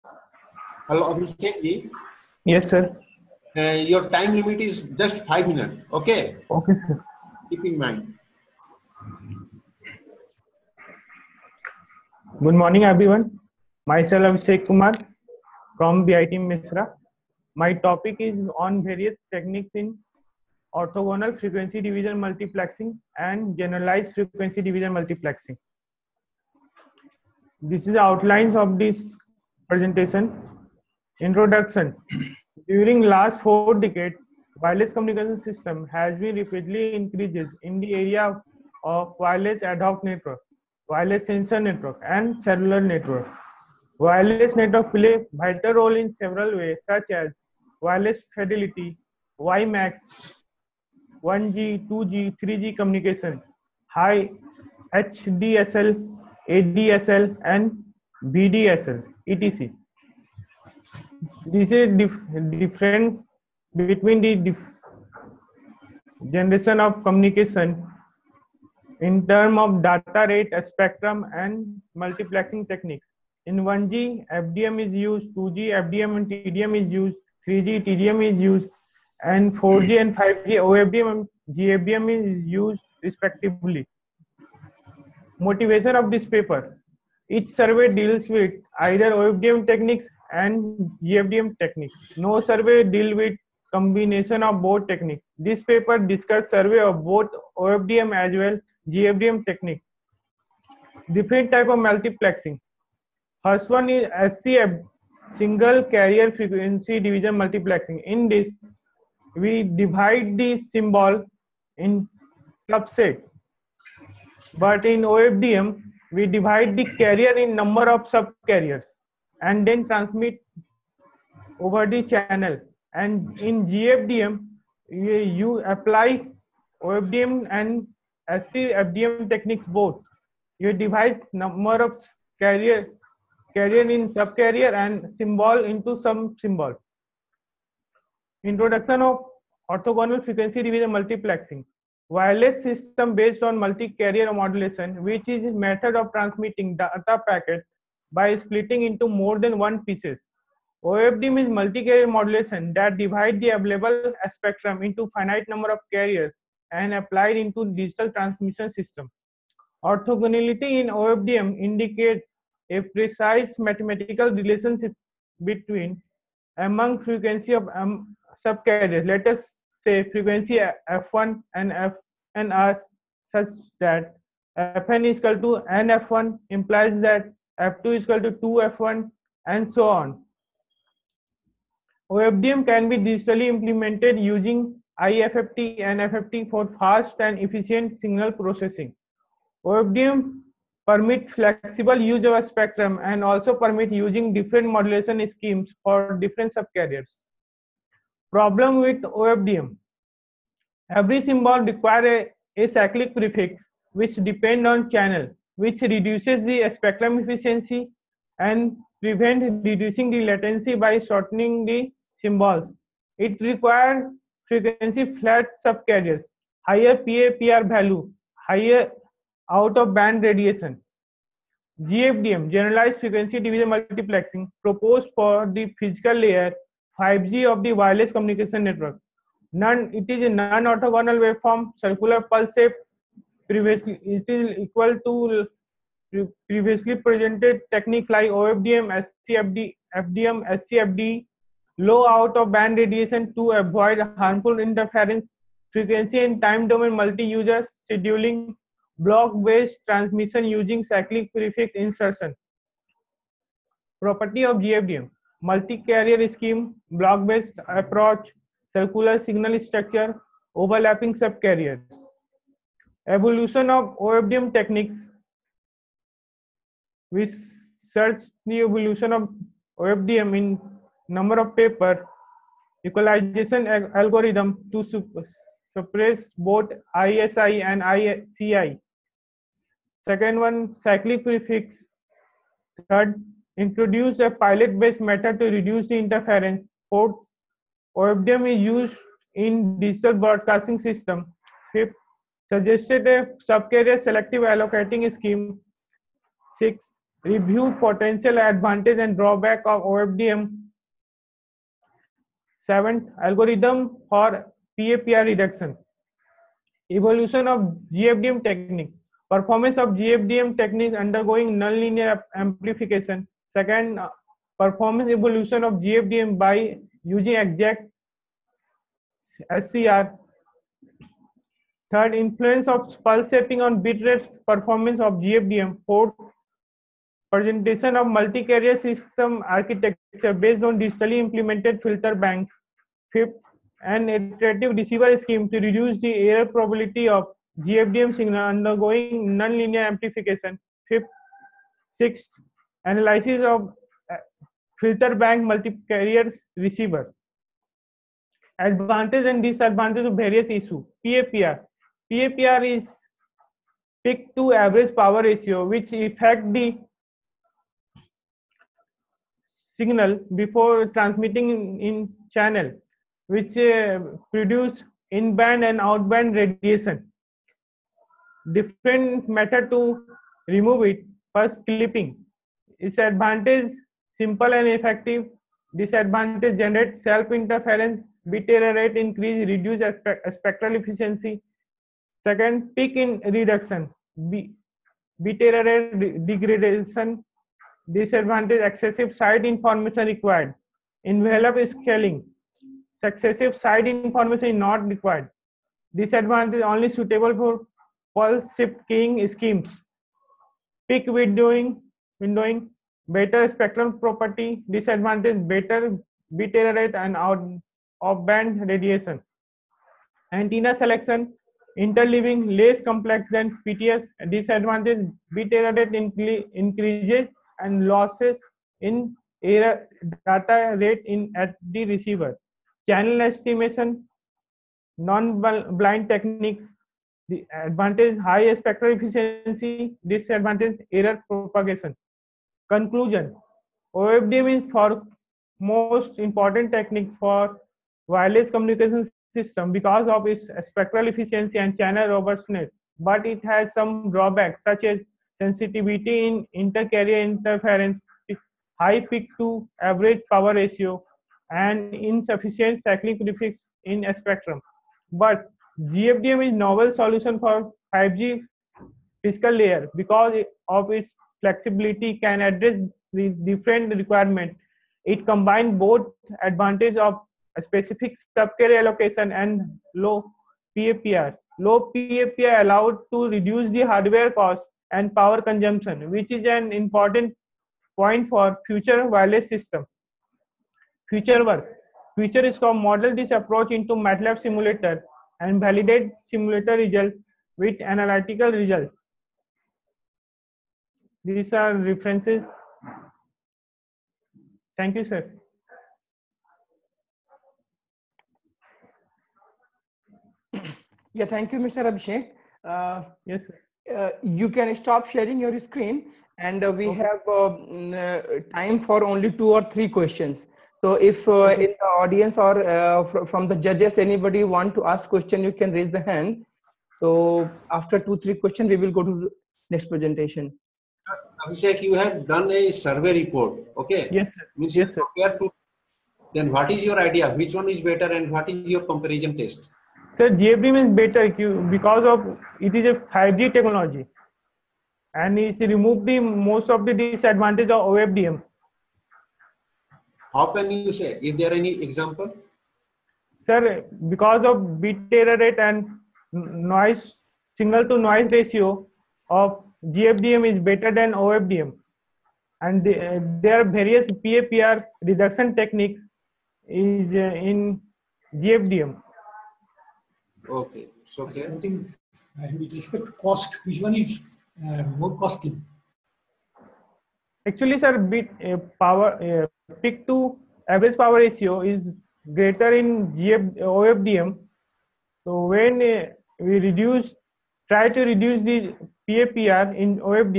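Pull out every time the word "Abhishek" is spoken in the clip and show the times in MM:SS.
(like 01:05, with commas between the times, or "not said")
00:14, 08:21, 08:41.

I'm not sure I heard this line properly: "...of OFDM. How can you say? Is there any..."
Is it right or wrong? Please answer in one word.
right.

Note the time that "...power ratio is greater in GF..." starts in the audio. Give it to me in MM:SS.
09:30.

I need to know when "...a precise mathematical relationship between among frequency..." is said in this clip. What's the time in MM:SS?
02:42.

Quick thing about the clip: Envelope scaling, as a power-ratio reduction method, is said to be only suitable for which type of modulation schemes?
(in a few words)
phase shift keying.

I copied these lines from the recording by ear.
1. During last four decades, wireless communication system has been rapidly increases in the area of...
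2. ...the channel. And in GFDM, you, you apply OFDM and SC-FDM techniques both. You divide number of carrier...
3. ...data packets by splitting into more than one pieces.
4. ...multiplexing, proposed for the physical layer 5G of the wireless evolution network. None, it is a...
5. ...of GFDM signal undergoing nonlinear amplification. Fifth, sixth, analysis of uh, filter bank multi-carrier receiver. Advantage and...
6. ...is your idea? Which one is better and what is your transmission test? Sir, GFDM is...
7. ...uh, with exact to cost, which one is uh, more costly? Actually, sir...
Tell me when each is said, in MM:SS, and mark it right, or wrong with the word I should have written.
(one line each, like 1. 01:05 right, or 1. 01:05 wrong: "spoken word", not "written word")
1. 00:32 right
2. 02:01 right
3. 02:26 right
4. 03:43 wrong: "communication", not "evolution"
5. 05:37 right
6. 08:46 wrong: "comparison", not "transmission"
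7. 09:22 wrong: "respect", not "exact".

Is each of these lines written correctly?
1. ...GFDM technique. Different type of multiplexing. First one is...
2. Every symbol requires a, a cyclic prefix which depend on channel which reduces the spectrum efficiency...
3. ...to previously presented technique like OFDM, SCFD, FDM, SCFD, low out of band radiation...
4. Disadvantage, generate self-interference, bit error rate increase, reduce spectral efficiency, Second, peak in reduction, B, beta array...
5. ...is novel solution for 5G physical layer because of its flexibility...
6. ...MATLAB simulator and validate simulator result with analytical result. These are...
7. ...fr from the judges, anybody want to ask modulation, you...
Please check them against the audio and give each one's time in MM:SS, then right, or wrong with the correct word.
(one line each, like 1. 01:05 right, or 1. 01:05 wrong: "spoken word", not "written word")
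1. 01:38 right
2. 03:20 right
3. 03:55 right
4. 06:15 right
5. 07:36 right
6. 08:03 right
7. 08:33 wrong: "question", not "modulation".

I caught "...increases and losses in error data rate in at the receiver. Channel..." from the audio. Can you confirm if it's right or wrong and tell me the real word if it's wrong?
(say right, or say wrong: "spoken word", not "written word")
right.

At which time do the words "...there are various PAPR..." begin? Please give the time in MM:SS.
09:13.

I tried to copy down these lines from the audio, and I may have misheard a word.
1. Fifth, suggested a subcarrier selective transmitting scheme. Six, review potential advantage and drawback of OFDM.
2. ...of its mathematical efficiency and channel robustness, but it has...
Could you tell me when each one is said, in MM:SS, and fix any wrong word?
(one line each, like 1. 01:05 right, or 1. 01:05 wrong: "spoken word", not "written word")
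1. 04:51 wrong: "allocating", not "transmitting"
2. 07:20 wrong: "spectral", not "mathematical".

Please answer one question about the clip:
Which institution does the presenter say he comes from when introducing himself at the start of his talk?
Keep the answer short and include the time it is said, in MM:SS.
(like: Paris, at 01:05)
BIT Mesra, at 00:16.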